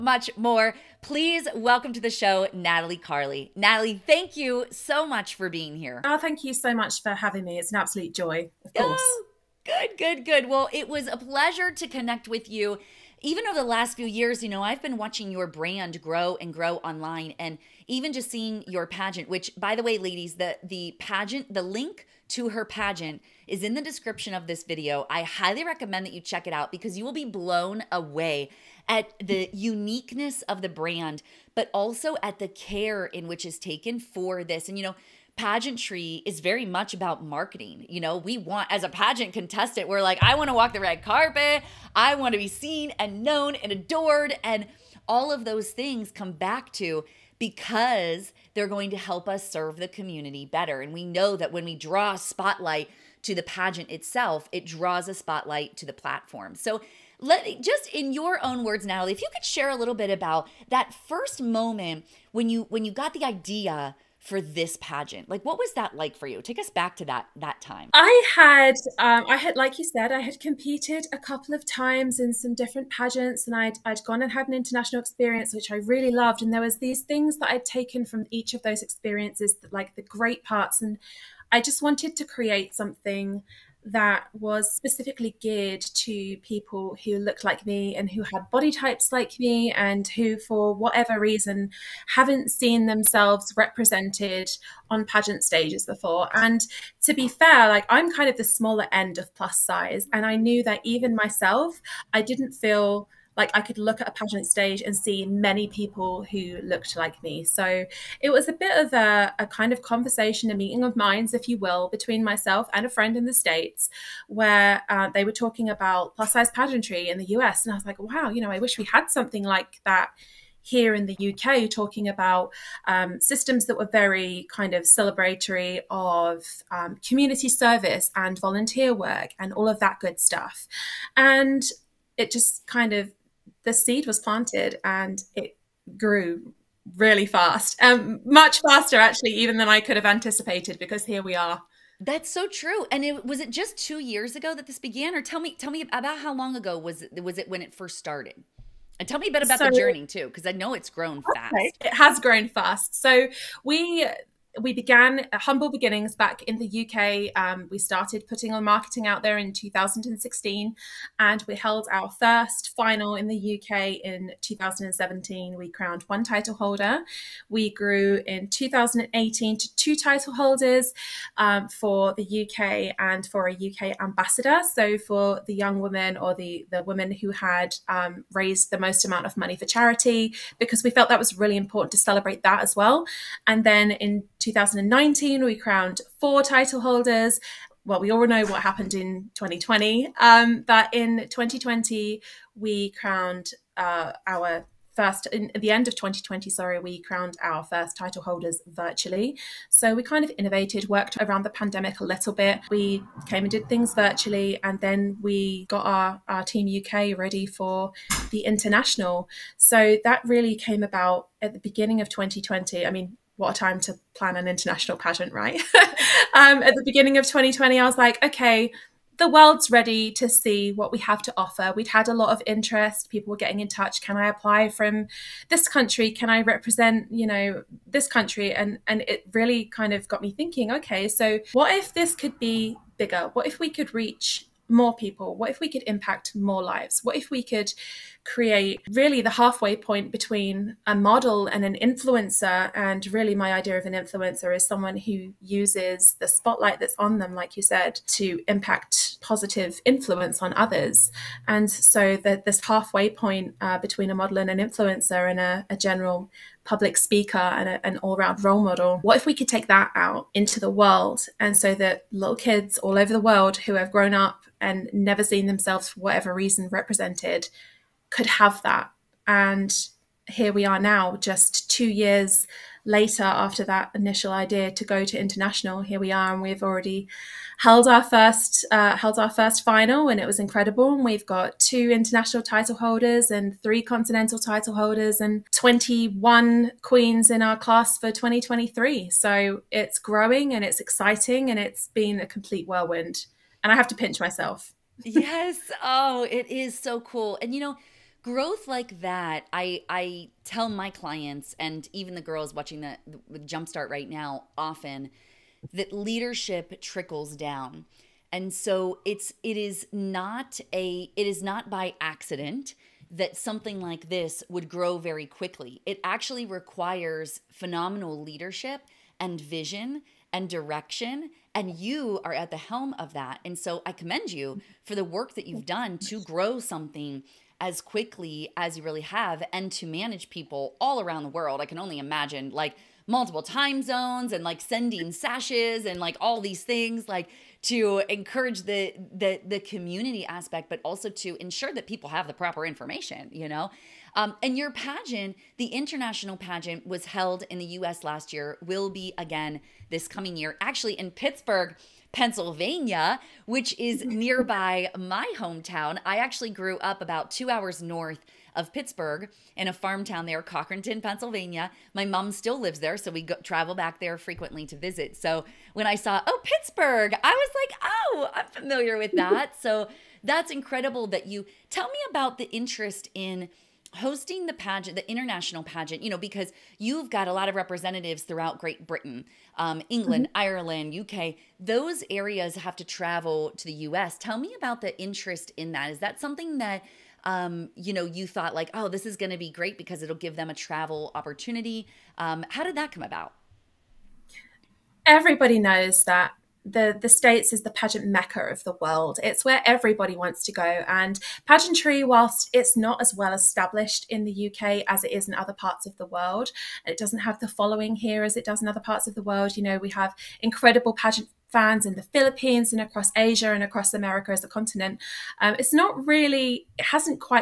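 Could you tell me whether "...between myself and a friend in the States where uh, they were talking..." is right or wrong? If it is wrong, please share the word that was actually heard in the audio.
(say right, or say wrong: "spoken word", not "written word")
right.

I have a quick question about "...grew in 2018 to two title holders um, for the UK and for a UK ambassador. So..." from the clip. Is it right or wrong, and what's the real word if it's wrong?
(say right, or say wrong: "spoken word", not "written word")
right.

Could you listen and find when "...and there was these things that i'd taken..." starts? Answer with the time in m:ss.
1:16.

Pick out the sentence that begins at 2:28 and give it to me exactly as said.
And tell me a bit about so, the journey too, because I know it's grown okay.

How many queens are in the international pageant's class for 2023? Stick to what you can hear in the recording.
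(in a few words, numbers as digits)
21.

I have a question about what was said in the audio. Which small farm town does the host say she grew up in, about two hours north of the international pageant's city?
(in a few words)
Cochranton, Pennsylvania.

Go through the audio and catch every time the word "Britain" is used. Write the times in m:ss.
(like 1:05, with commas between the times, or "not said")
6:18.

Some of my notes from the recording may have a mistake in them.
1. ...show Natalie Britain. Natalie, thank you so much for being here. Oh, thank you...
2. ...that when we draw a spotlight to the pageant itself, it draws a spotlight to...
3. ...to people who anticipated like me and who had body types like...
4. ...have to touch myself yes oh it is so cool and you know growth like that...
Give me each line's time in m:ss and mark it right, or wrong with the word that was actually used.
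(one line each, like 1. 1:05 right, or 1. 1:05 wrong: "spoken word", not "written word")
1. 0:02 wrong: "Carley", not "Britain"
2. 0:51 right
3. 1:25 wrong: "looked", not "anticipated"
4. 4:53 wrong: "pinch", not "touch".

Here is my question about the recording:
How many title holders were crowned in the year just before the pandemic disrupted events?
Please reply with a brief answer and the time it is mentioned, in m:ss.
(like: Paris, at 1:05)
4, at 3:06.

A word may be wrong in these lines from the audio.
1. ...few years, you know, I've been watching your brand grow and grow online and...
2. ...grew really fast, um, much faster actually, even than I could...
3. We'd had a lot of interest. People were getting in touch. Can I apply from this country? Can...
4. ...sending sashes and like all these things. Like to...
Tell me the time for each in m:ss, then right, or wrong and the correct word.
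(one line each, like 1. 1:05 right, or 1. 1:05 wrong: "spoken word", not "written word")
1. 0:13 right
2. 2:15 right
3. 3:41 right
4. 5:34 right.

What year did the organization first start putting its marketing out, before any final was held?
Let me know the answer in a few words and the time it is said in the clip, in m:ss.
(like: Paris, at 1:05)
2016, at 2:39.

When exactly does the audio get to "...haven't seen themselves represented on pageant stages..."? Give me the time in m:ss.
1:32.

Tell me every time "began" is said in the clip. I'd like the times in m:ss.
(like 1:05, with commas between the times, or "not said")
2:24, 2:34.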